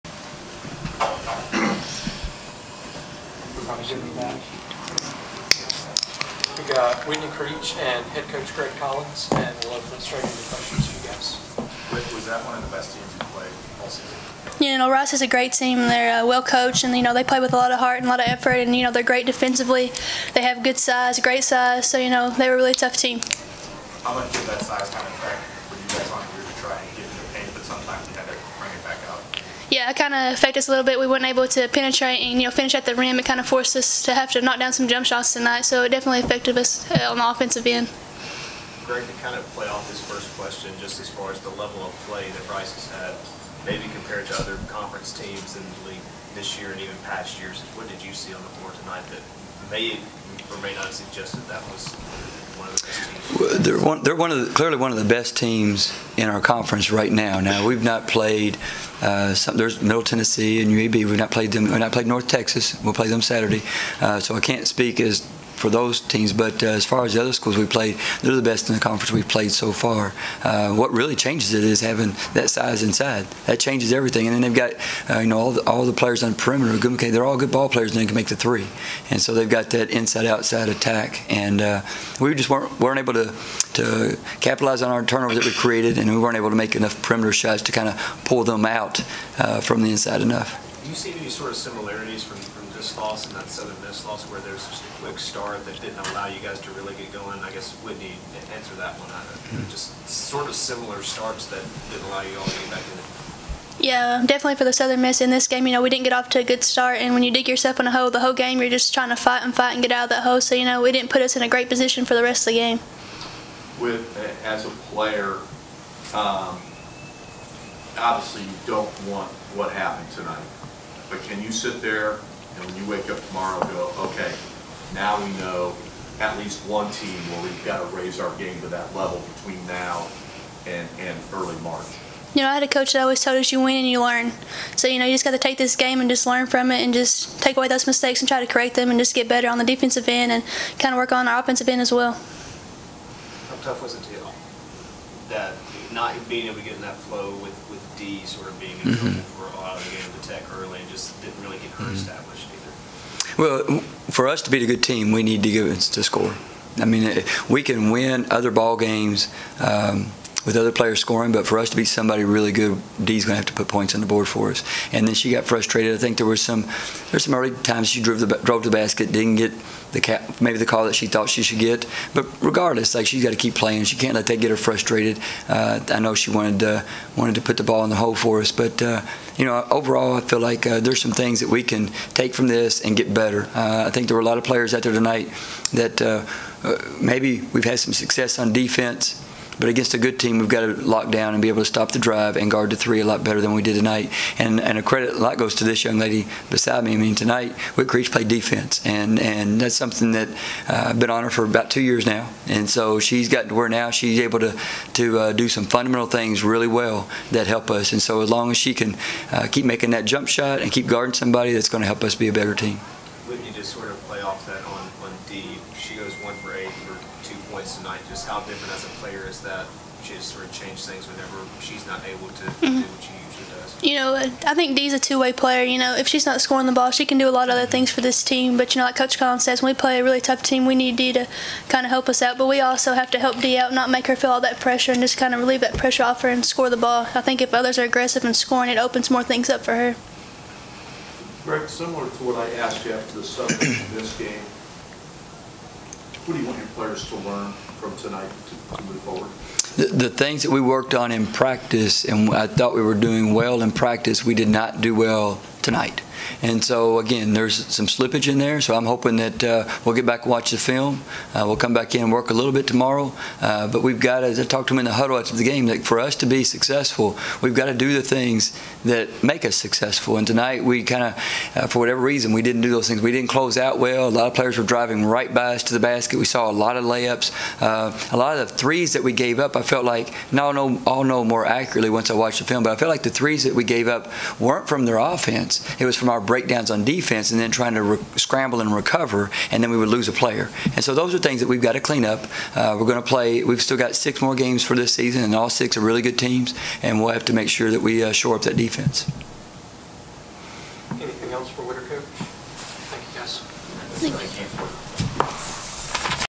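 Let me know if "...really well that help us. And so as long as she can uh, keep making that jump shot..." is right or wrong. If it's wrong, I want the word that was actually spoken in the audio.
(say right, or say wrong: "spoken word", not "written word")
right.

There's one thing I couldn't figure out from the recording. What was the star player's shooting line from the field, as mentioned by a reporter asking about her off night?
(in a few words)
1 for 8.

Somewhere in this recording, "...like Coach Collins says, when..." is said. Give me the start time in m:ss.
3:48.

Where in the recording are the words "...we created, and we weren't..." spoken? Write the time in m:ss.
1:25.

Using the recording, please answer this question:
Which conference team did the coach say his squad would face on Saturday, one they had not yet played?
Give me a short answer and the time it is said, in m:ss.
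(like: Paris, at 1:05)
North Texas, at 1:02.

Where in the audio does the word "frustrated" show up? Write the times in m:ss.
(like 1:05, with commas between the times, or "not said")
2:45, 2:54.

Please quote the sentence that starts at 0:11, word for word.
Rick, was that one of the best teams you played all season?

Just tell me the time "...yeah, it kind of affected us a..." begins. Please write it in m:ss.
0:29.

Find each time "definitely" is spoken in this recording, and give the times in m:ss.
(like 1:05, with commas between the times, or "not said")
0:35, 1:44.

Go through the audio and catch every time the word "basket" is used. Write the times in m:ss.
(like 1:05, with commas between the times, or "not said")
2:48, 4:35.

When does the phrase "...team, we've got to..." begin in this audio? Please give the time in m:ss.
3:10.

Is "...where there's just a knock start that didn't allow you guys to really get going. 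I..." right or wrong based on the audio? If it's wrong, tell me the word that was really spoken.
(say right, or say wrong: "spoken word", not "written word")
wrong: "quick", not "knock".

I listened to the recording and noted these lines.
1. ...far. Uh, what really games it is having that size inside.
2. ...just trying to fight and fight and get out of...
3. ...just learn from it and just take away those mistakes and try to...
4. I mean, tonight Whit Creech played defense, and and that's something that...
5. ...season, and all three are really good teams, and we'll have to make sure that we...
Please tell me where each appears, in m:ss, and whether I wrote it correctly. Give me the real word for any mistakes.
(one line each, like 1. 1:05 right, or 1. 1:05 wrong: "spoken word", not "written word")
1. 1:09 wrong: "changes", not "games"
2. 1:48 right
3. 2:16 right
4. 3:16 right
5. 4:54 wrong: "six", not "three".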